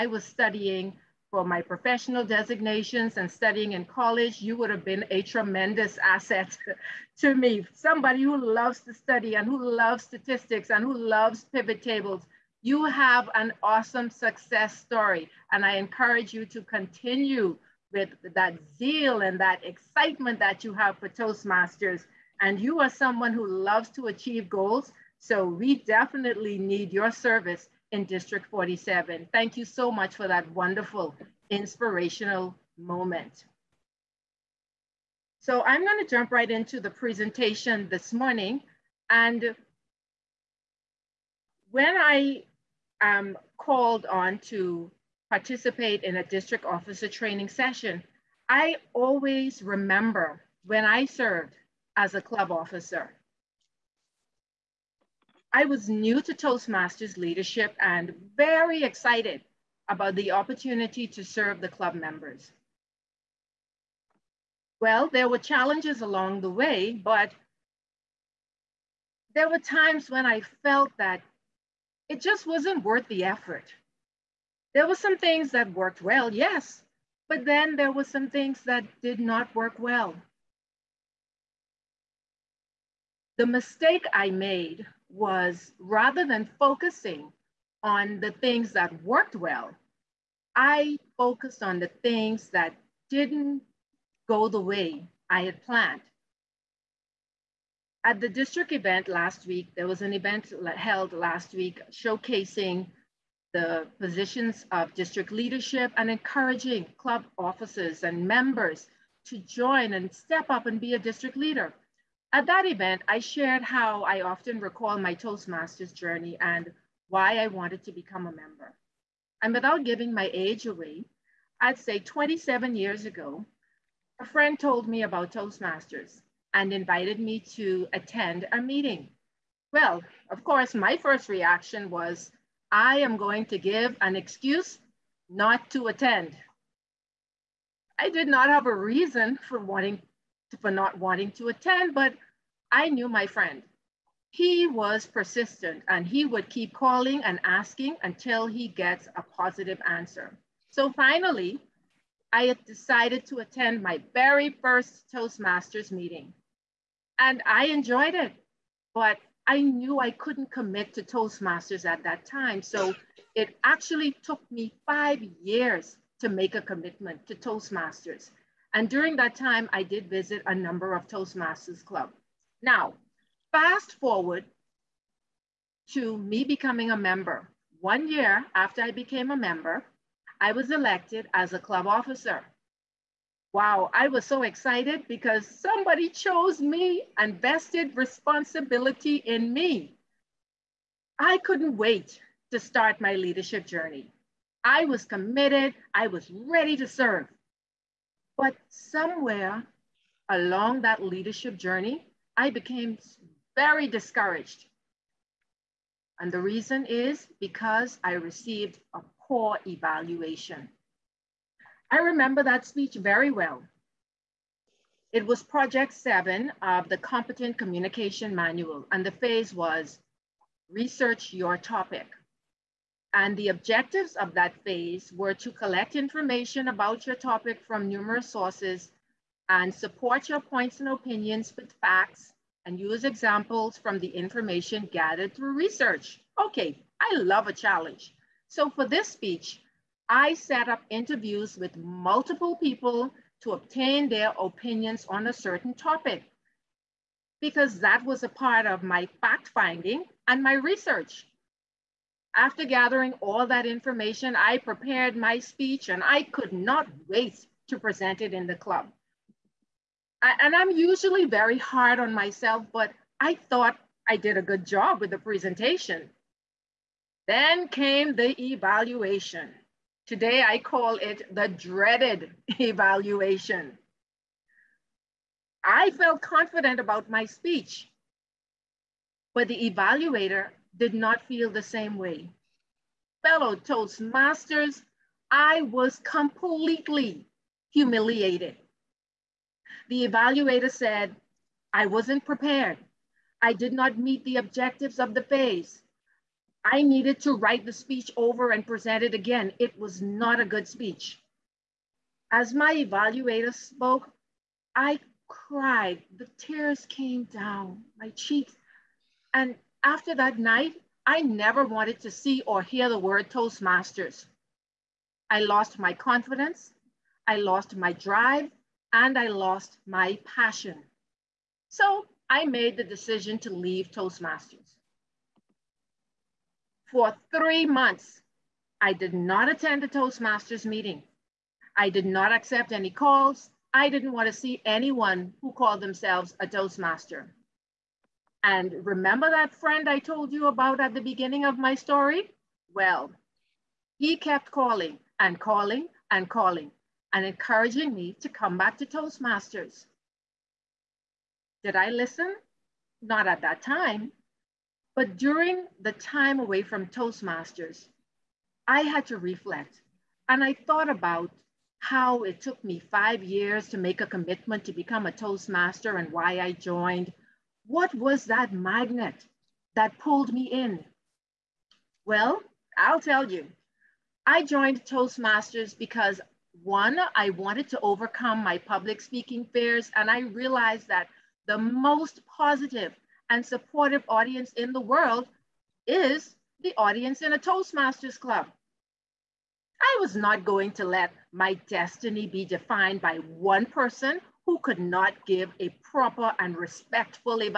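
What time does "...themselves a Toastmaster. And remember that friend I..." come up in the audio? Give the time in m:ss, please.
5:35.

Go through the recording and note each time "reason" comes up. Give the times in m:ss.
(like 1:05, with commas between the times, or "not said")
2:18, 3:26.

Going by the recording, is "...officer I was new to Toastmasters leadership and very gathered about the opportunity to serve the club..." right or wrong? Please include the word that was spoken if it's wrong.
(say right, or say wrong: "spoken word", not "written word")
wrong: "excited", not "gathered".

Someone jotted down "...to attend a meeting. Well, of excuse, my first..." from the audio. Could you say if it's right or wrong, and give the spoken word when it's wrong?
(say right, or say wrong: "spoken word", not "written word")
wrong: "course", not "excuse".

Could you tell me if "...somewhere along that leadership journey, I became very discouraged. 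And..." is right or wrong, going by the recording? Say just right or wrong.
right.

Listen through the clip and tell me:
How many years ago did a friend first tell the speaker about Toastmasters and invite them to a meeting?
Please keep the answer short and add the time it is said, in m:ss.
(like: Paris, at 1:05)
27, at 2:01.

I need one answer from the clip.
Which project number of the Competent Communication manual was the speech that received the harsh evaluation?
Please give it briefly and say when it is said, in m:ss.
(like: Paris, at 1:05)
7, at 3:35.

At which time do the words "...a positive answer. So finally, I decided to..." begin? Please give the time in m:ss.
2:29.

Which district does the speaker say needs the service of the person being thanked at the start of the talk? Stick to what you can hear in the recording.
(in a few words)
District 47.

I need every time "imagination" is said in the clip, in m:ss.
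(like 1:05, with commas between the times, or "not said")
not said.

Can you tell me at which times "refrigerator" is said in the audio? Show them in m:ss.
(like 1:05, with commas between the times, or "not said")
not said.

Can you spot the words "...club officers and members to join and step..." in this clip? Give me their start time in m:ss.
1:46.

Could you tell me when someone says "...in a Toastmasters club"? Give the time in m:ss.
6:27.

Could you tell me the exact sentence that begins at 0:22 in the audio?
And you are someone who loves to achieve goals.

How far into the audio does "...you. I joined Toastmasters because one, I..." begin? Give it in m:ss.
6:13.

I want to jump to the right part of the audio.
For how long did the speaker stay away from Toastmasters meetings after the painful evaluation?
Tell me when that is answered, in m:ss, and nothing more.
5:27.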